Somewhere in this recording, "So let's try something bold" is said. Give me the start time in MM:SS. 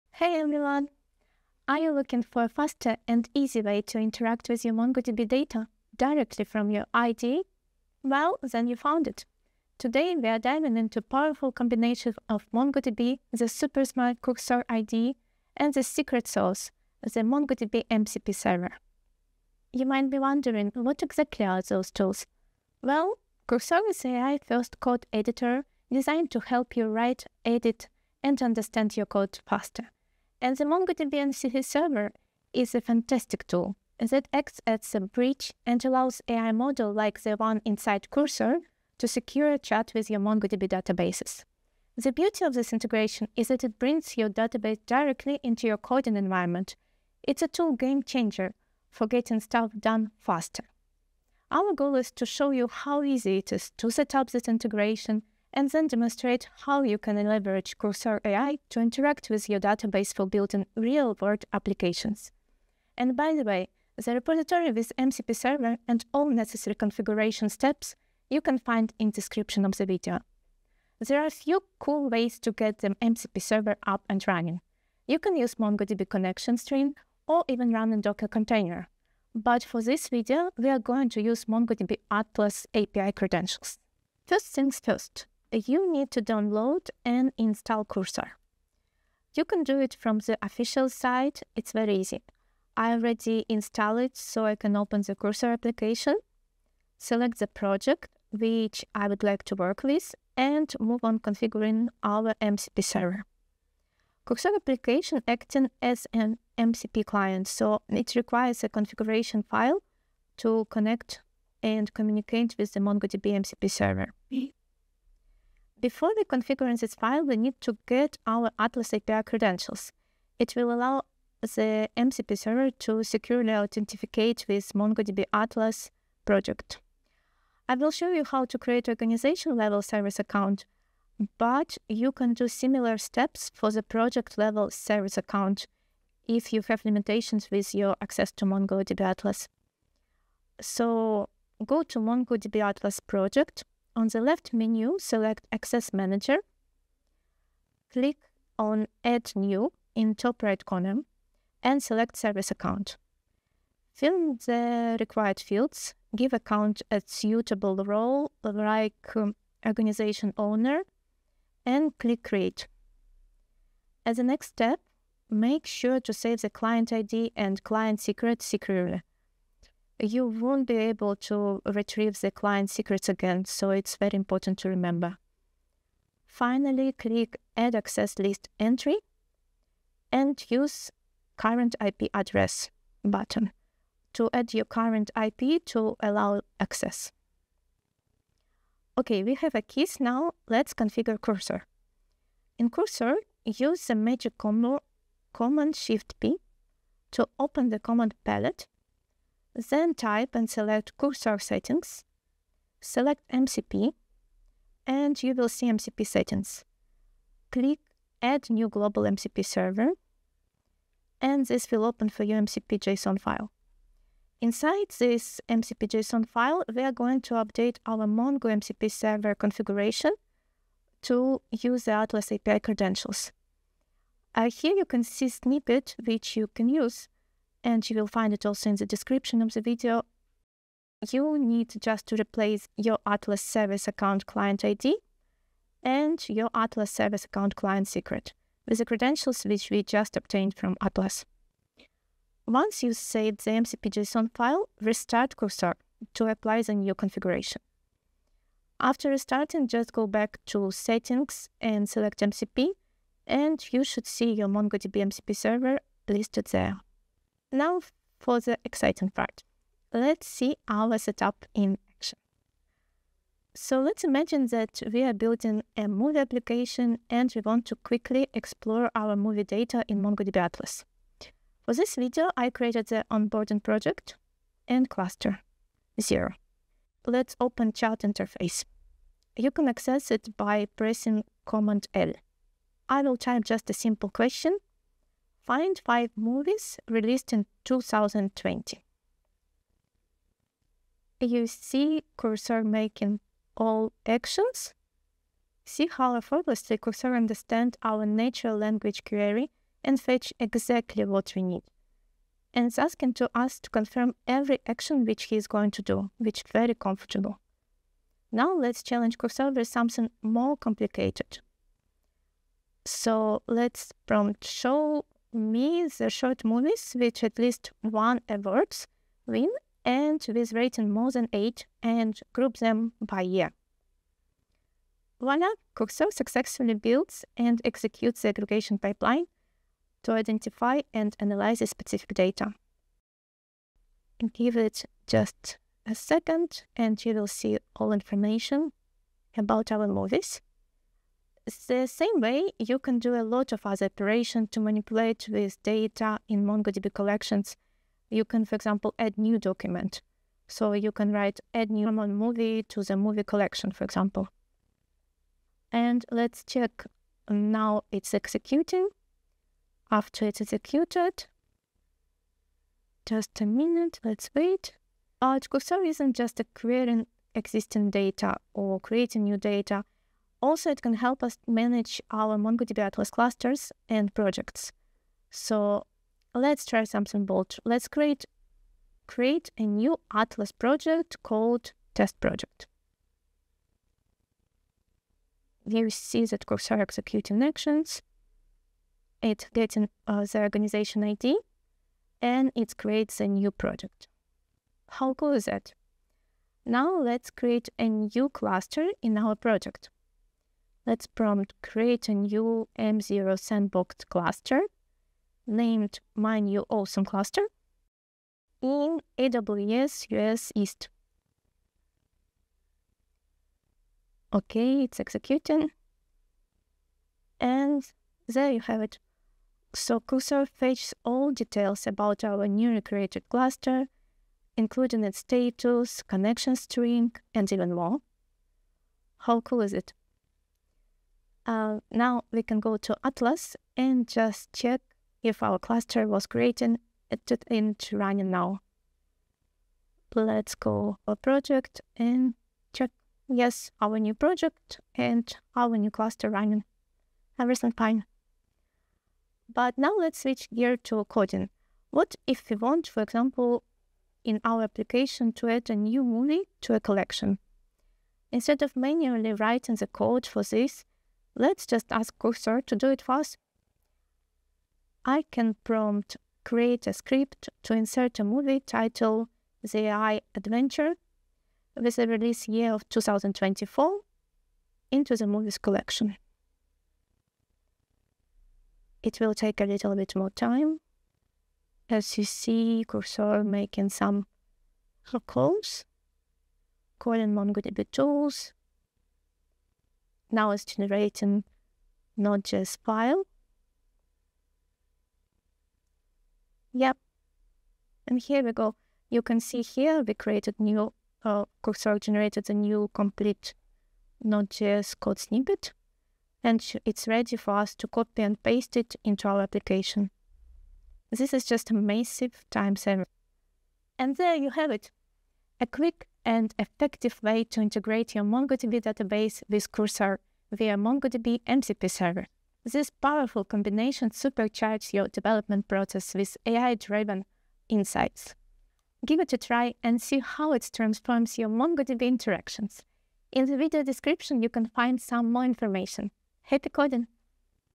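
06:15.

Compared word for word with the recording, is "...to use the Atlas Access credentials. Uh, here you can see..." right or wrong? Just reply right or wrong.
wrong.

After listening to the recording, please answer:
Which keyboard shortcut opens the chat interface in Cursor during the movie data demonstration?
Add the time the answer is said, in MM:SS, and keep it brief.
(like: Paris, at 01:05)
Command L, at 04:41.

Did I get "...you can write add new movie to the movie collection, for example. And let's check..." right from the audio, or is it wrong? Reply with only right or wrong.
right.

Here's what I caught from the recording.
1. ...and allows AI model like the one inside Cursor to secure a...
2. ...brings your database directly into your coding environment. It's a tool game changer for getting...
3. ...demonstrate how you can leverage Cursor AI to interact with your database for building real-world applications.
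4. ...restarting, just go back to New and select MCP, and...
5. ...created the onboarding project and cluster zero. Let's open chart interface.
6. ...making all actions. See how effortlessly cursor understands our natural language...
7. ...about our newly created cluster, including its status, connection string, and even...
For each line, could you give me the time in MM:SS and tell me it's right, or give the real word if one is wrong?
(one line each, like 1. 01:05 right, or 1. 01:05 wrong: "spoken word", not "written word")
1. 00:35 right
2. 00:43 right
3. 00:55 right
4. 04:09 wrong: "Settings", not "New"
5. 04:32 right
6. 04:52 right
7. 07:01 right.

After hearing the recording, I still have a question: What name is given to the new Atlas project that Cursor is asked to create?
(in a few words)
test project.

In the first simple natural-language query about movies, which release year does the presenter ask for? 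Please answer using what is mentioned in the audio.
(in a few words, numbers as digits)
2020.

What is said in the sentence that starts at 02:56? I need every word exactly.
Finally, click Add Access List Entry and use Current IP Address button to add your current IP to allow access.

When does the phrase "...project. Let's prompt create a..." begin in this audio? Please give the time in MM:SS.
06:39.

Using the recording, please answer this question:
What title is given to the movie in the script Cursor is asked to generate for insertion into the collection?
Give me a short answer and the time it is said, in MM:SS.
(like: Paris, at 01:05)
The AI Adventure, at 07:49.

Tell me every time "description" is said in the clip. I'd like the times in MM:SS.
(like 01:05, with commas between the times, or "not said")
01:09, 03:48, 08:53.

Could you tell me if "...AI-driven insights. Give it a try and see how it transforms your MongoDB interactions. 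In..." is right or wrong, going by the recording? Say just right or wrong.
right.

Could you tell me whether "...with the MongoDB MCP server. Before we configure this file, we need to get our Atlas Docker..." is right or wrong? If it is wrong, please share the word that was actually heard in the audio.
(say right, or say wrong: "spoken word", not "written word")
wrong: "API", not "Docker".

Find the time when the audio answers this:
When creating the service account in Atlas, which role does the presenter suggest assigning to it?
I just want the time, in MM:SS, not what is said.
02:39.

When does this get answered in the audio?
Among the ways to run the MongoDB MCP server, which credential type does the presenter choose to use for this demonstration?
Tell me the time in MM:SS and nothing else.
01:21.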